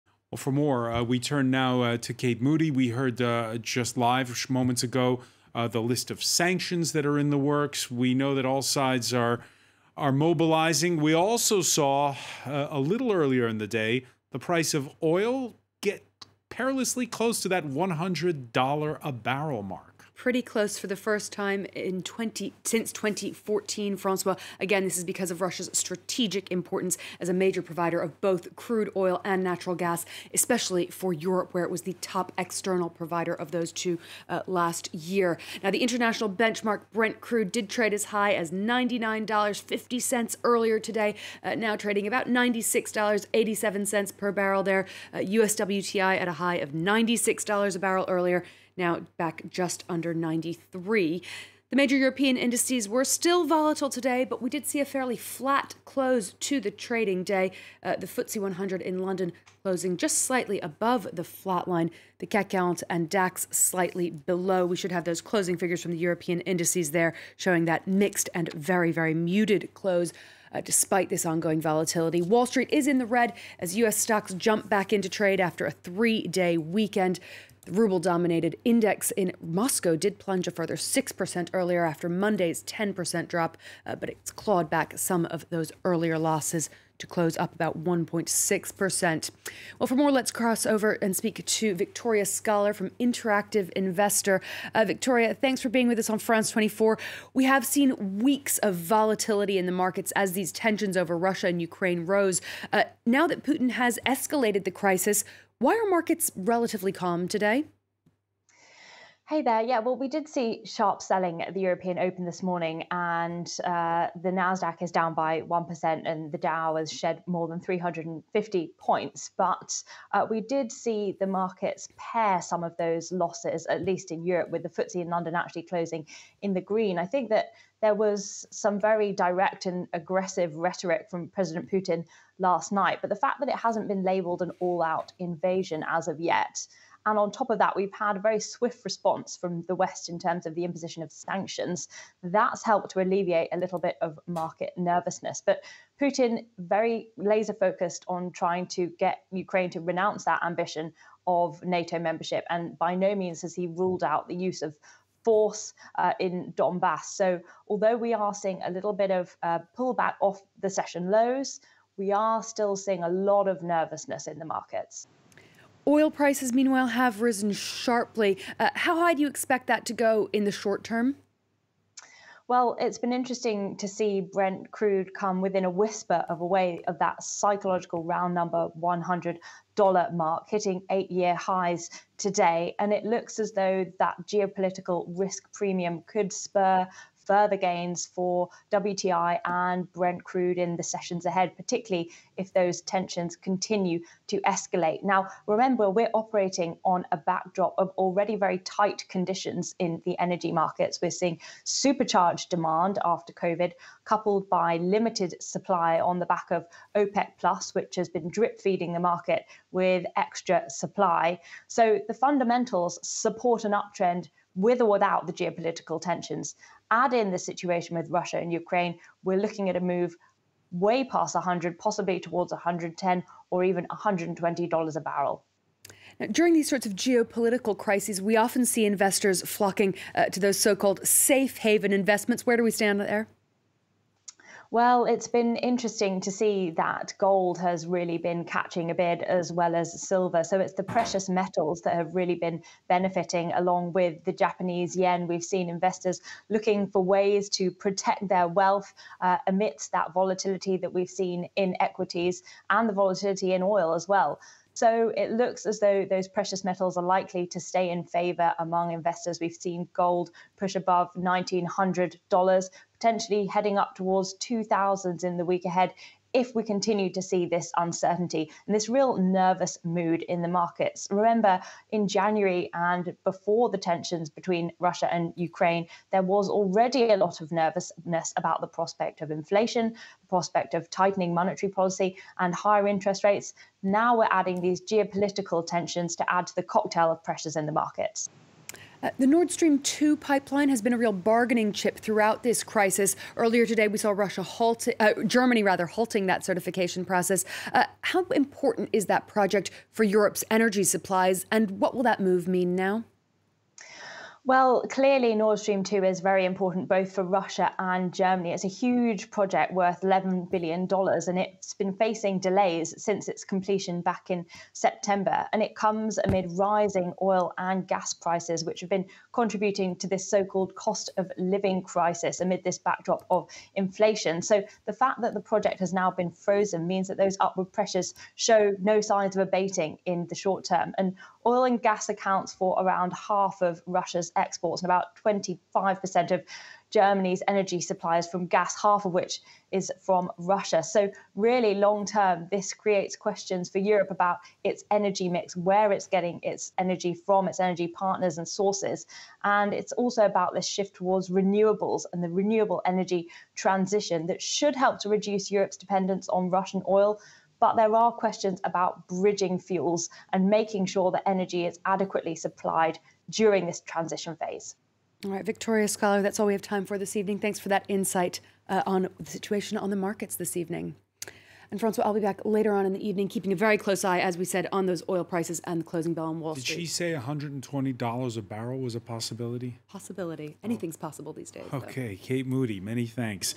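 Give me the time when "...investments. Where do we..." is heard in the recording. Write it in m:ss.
3:51.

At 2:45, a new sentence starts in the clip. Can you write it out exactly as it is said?
Oil prices, meanwhile, have risen sharply.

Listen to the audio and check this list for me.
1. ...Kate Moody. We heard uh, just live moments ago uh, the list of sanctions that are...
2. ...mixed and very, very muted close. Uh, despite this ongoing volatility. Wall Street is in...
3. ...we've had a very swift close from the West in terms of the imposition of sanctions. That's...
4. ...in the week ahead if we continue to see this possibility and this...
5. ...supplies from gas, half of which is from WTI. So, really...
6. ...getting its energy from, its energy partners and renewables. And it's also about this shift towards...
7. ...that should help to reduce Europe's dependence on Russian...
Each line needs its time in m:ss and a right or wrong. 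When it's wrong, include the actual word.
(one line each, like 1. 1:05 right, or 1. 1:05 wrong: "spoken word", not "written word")
1. 0:02 right
2. 1:07 right
3. 2:17 wrong: "response", not "close"
4. 4:25 wrong: "uncertainty", not "possibility"
5. 5:37 wrong: "Russia", not "WTI"
6. 5:46 wrong: "sources", not "renewables"
7. 5:54 right.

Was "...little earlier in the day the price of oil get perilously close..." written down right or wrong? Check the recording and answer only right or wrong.
right.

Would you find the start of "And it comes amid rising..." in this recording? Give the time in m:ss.
5:15.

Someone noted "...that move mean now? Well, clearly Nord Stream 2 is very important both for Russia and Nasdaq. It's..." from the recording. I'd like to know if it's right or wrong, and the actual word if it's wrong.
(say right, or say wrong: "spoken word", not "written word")
wrong: "Germany", not "Nasdaq".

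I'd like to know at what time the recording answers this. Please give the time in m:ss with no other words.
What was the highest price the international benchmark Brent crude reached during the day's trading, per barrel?
0:38.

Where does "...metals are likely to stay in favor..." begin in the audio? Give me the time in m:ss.
4:16.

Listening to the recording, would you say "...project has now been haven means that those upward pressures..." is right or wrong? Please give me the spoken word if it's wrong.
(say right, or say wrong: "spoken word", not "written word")
wrong: "frozen", not "haven".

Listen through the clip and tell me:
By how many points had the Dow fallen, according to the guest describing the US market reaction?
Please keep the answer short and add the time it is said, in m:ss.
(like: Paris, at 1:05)
350, at 1:57.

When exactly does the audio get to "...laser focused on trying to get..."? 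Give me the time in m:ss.
2:27.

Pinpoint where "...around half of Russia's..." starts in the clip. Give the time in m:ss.
5:32.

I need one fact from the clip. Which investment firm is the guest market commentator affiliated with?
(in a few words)
Interactive Investor.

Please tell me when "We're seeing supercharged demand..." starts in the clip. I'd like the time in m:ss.
3:21.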